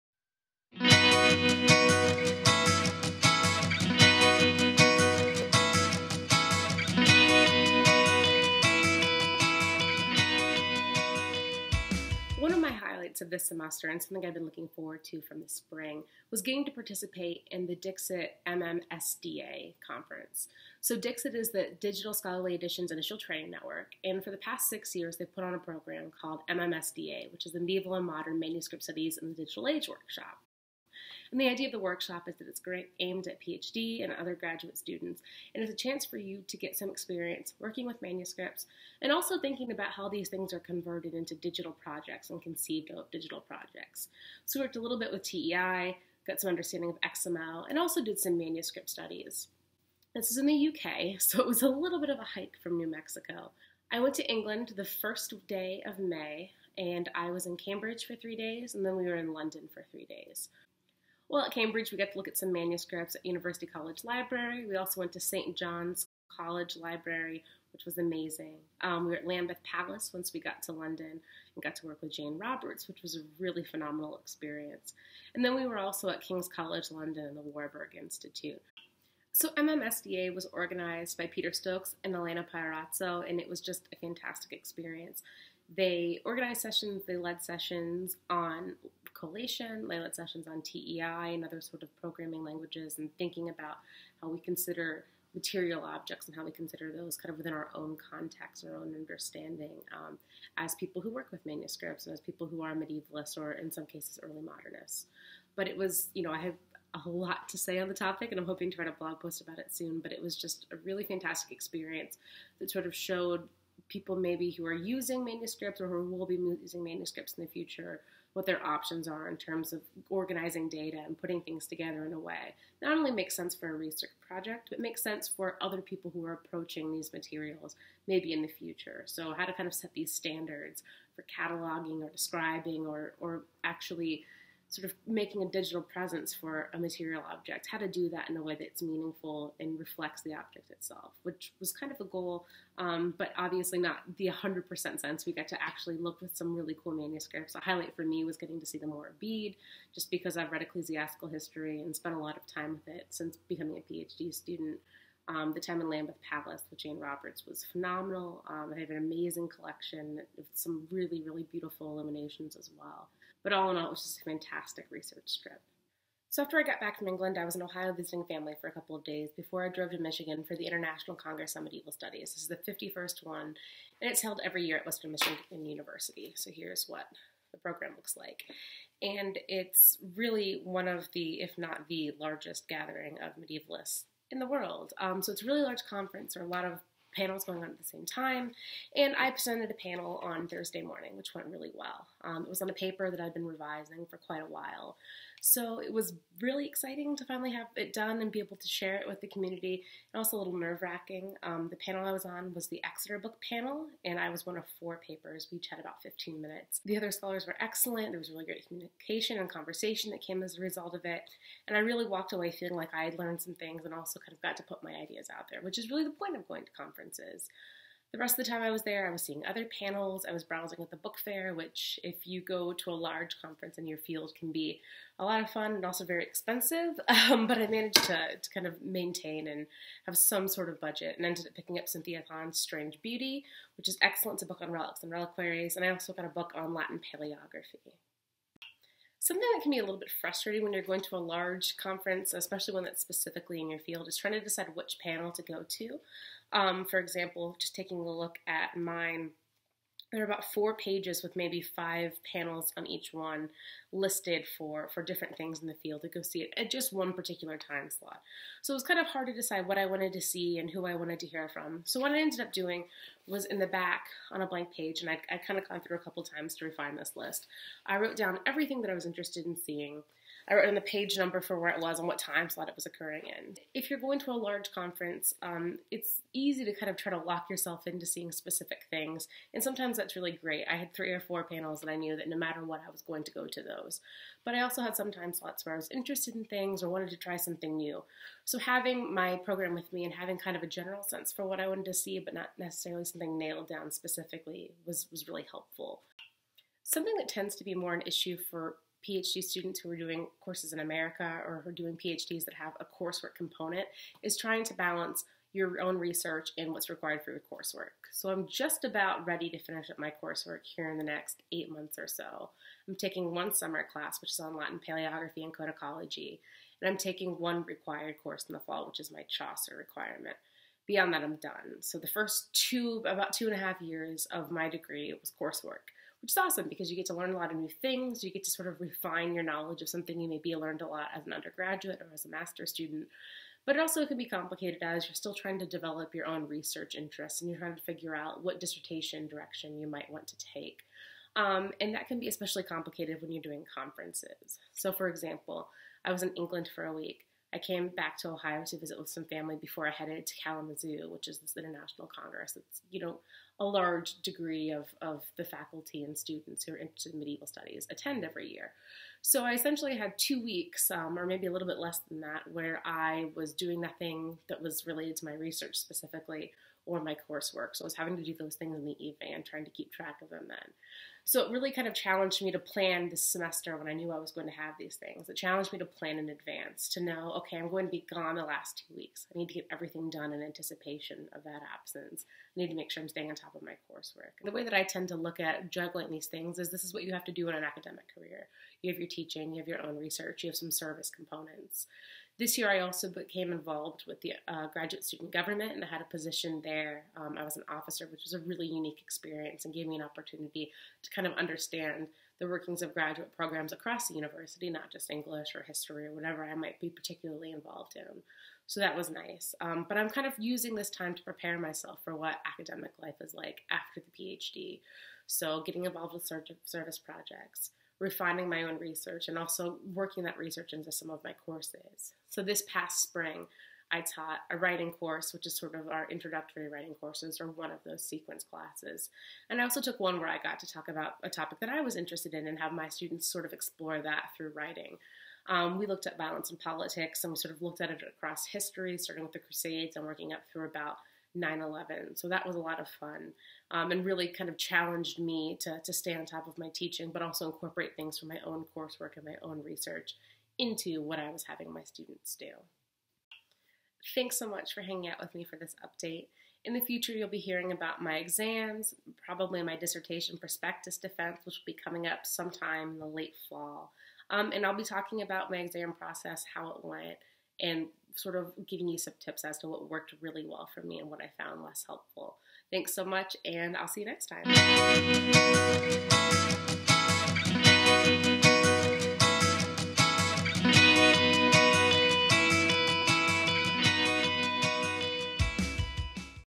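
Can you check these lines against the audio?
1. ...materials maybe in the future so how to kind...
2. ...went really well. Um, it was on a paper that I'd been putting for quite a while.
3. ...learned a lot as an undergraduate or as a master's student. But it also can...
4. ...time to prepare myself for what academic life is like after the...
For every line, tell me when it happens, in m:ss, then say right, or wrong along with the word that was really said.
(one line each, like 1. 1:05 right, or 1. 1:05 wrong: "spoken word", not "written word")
1. 2:07 right
2. 3:11 wrong: "revising", not "putting"
3. 5:30 right
4. 6:50 right.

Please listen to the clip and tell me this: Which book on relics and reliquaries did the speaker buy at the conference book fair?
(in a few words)
Strange Beauty.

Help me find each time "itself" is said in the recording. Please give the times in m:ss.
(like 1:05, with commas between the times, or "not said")
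2:20.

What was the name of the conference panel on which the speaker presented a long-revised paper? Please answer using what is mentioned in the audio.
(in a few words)
Exeter Book Panel.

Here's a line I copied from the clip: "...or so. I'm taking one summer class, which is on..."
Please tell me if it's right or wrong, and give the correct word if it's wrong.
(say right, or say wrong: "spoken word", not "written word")
right.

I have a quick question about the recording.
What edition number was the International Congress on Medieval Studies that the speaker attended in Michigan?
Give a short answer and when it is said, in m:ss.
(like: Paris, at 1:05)
51st, at 2:52.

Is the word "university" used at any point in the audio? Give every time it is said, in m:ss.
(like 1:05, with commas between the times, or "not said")
1:03, 2:55, 6:44.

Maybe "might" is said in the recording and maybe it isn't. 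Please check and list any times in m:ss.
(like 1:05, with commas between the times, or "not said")
5:39, 6:46.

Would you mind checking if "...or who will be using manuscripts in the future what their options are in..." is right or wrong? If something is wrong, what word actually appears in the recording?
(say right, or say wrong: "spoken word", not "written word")
right.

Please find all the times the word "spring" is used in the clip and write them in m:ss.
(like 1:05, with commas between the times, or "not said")
0:15, 7:03.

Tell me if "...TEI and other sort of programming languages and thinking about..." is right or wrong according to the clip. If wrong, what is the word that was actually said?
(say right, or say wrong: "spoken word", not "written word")
right.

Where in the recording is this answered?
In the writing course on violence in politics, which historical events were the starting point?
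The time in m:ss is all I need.
7:19.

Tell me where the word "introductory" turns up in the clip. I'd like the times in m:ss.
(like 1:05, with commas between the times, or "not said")
7:06.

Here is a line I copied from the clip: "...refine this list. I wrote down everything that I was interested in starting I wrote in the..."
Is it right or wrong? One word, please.
wrong.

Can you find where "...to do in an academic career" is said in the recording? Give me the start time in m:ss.
6:27.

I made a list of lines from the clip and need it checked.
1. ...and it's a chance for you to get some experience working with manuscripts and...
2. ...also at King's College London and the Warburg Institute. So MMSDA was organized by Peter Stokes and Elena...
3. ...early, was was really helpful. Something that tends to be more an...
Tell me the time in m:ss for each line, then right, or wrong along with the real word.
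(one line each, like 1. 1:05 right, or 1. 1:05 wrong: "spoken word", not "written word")
1. 0:35 right
2. 1:15 right
3. 4:53 wrong: "specifically", not "early".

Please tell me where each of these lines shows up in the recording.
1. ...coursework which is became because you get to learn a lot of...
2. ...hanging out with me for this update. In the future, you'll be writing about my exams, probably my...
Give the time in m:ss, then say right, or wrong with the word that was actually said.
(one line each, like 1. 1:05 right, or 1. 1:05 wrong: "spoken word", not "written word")
1. 5:25 wrong: "awesome", not "became"
2. 7:34 wrong: "hearing", not "writing".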